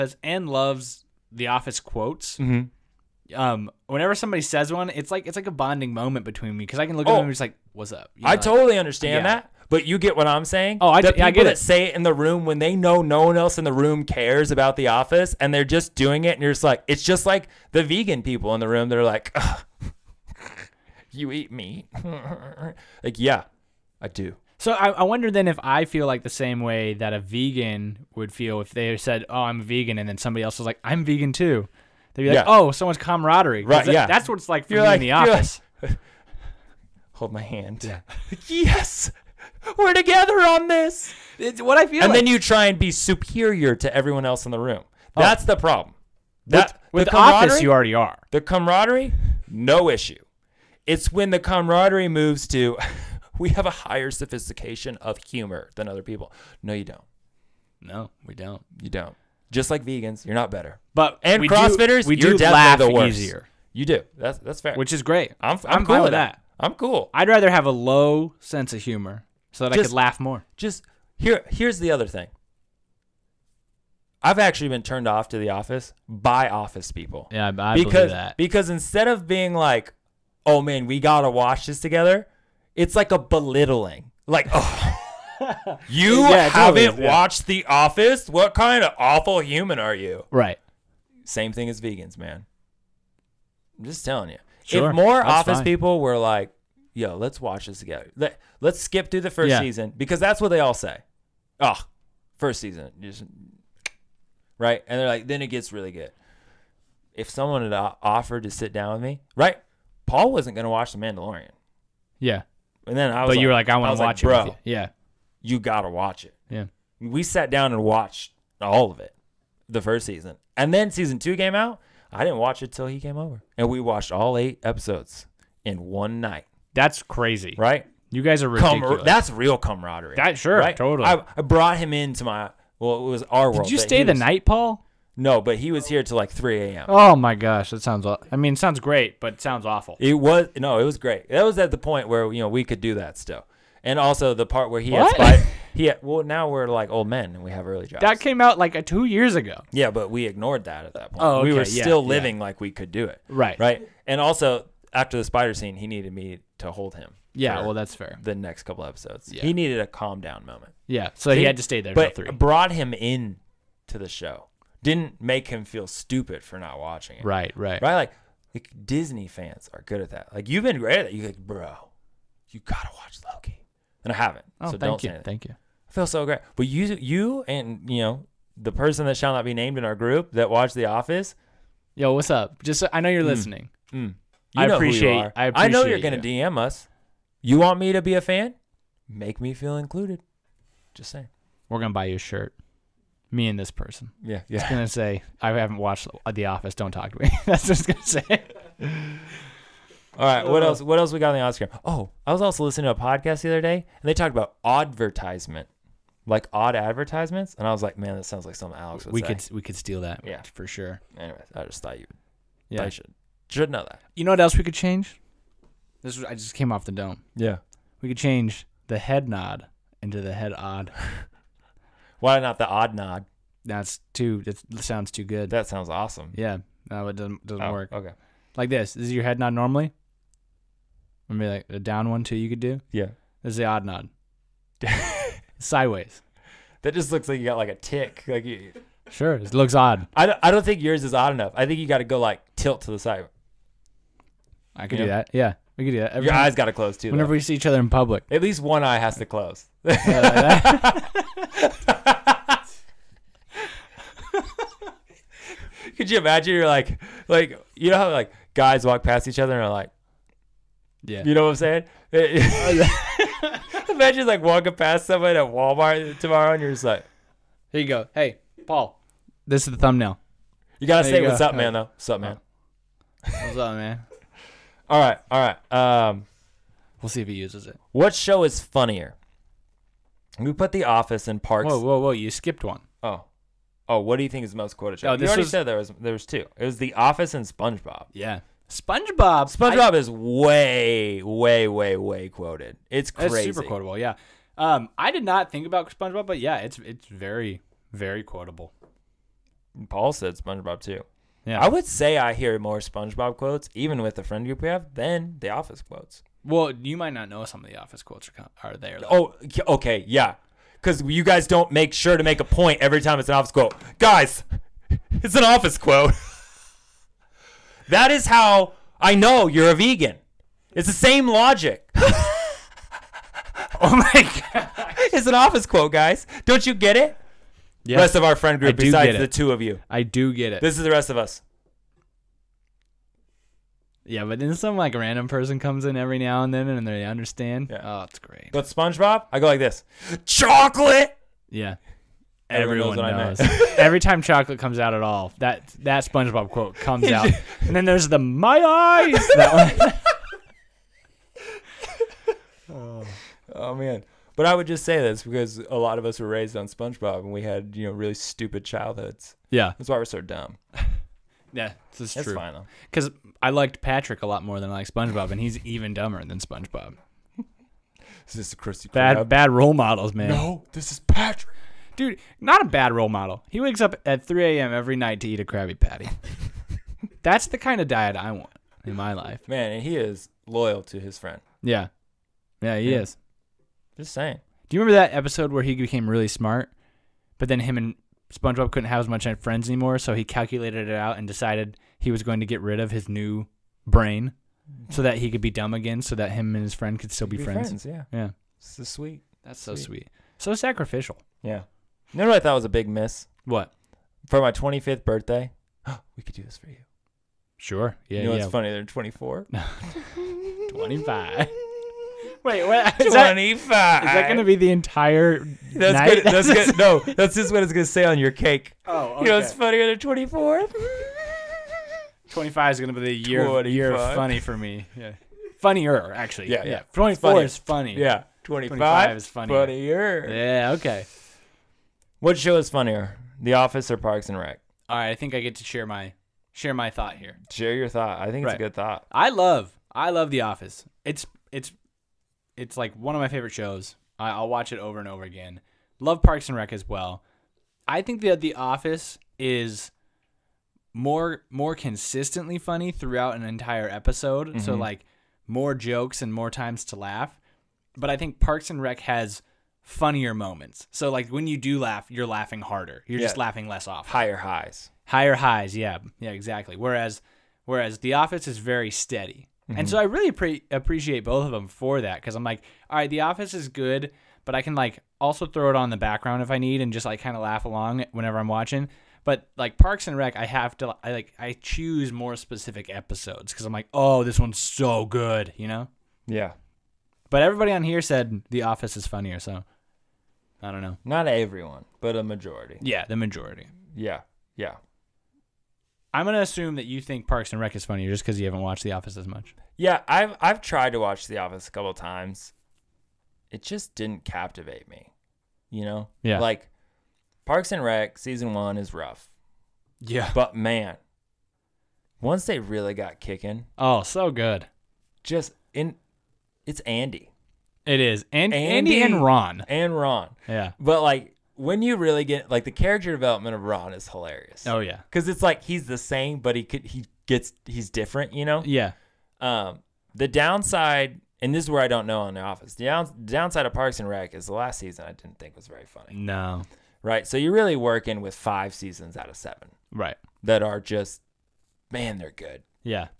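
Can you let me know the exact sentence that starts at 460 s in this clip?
So like when you do laugh, you're laughing harder.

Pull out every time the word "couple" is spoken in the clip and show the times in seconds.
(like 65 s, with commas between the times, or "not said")
158 s, 501 s.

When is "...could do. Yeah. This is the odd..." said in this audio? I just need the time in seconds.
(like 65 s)
232 s.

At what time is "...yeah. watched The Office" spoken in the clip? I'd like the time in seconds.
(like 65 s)
87 s.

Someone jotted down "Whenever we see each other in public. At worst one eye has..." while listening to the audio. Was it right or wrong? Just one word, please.
wrong.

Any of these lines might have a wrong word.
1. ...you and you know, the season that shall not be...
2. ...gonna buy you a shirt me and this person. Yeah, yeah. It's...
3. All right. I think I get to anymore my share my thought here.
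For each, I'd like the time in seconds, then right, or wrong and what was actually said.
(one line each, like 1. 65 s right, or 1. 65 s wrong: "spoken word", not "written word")
1. 176 s wrong: "person", not "season"
2. 191 s right
3. 434 s wrong: "share", not "anymore".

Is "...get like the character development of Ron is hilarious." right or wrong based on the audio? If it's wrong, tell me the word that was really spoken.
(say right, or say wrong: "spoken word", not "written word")
right.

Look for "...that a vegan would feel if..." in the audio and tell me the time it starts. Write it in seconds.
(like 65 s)
26 s.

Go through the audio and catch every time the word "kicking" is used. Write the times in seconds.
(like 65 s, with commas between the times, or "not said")
513 s.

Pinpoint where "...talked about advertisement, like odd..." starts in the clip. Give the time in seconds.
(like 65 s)
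204 s.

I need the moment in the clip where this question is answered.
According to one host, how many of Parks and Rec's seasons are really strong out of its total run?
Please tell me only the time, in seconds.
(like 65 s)
538 s.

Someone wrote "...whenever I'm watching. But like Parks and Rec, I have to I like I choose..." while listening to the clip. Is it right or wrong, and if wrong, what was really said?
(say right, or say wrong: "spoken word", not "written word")
right.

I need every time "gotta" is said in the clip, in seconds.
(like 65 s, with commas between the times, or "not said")
80 s, 115 s, 172 s, 270 s.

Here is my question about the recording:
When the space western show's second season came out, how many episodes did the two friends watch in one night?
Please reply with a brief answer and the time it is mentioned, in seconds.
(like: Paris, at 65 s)
8, at 124 s.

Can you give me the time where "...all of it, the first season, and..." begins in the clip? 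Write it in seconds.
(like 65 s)
118 s.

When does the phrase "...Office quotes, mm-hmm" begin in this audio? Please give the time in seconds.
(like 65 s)
1 s.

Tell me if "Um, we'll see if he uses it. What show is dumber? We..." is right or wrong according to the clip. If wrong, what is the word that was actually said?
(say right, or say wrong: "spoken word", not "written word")
wrong: "funnier", not "dumber".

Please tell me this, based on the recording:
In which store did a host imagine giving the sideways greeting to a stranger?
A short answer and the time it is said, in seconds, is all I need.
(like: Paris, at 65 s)
Walmart, at 265 s.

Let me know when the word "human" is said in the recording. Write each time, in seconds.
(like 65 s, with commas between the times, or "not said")
89 s.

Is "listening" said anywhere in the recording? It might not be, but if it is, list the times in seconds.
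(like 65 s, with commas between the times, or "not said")
183 s, 202 s.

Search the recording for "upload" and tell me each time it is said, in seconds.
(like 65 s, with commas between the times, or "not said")
not said.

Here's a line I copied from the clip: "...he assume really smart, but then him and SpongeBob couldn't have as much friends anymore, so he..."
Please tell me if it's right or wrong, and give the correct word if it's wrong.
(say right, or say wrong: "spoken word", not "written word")
wrong: "became", not "assume".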